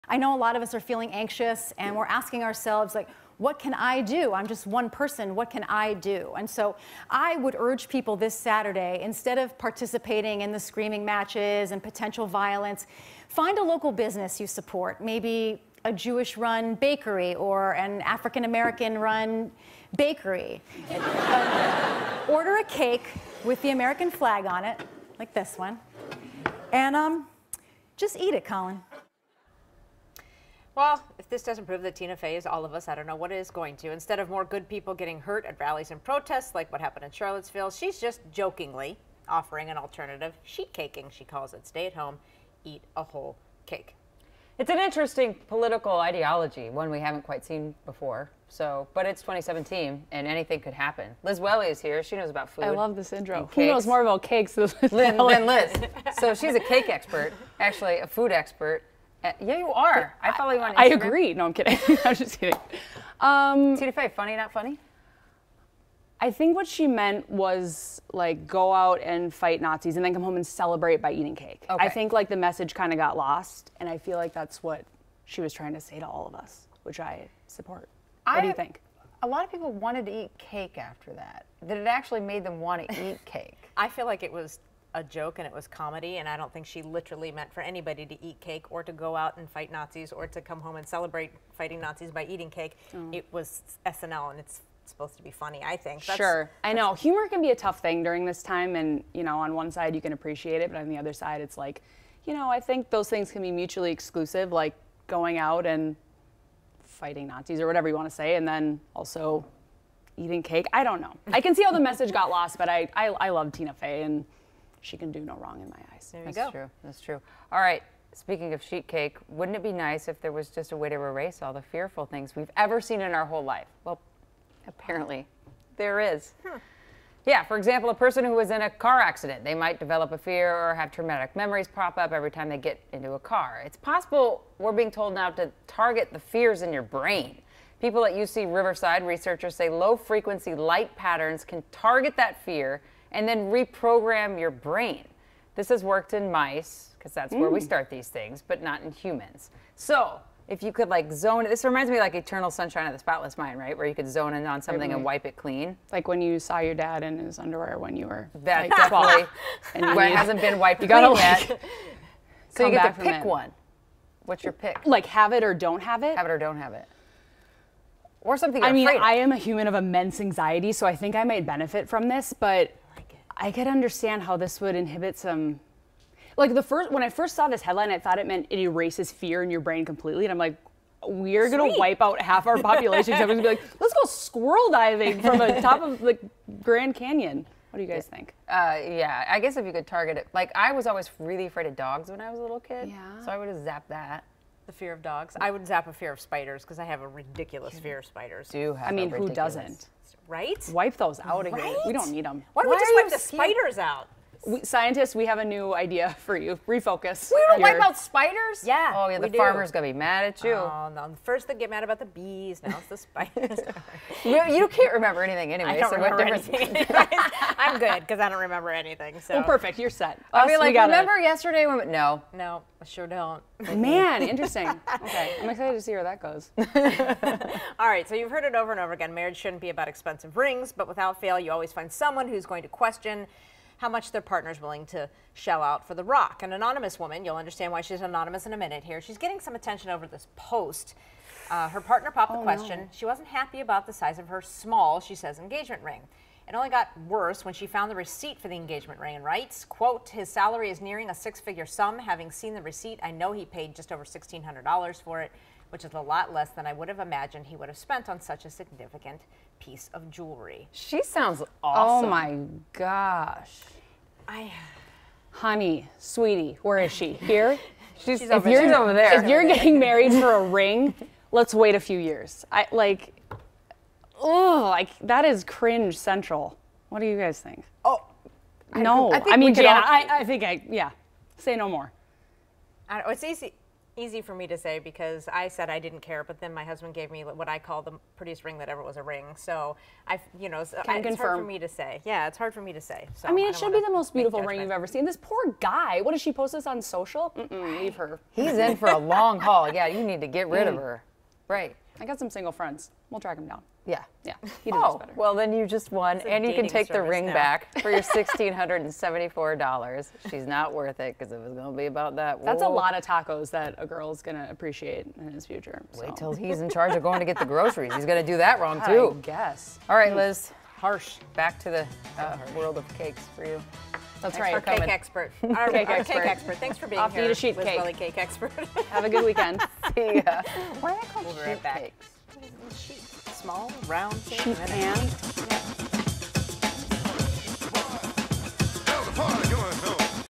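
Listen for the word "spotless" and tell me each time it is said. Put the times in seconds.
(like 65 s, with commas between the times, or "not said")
152 s.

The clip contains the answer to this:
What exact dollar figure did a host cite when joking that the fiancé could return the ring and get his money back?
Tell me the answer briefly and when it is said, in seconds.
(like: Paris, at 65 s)
$1,674, at 308 s.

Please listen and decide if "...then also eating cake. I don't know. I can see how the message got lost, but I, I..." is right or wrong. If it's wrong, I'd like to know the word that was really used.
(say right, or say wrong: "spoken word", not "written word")
right.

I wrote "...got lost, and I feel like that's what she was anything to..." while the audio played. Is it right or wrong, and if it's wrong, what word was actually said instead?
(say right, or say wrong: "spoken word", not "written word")
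wrong: "trying", not "anything".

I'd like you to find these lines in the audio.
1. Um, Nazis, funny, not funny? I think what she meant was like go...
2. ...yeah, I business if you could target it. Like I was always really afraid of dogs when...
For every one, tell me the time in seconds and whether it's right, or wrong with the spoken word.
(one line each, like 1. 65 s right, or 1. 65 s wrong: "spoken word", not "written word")
1. 63 s wrong: "TDFA", not "Nazis"
2. 188 s wrong: "guess", not "business".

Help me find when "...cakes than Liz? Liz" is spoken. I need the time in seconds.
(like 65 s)
54 s.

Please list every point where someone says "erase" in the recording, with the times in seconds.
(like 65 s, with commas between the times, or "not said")
120 s, 178 s.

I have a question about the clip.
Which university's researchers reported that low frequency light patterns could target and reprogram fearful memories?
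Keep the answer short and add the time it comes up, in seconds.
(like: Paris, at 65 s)
UC Riverside, at 138 s.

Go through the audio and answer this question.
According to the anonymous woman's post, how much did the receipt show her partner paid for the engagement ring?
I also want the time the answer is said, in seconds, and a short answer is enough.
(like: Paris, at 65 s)
just over $1,600, at 253 s.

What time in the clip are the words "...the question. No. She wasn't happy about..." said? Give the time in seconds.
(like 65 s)
242 s.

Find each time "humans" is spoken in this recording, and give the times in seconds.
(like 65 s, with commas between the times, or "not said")
148 s, 169 s.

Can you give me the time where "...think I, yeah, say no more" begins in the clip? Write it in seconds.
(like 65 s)
280 s.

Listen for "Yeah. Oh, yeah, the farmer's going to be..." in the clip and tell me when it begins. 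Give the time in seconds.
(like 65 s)
208 s.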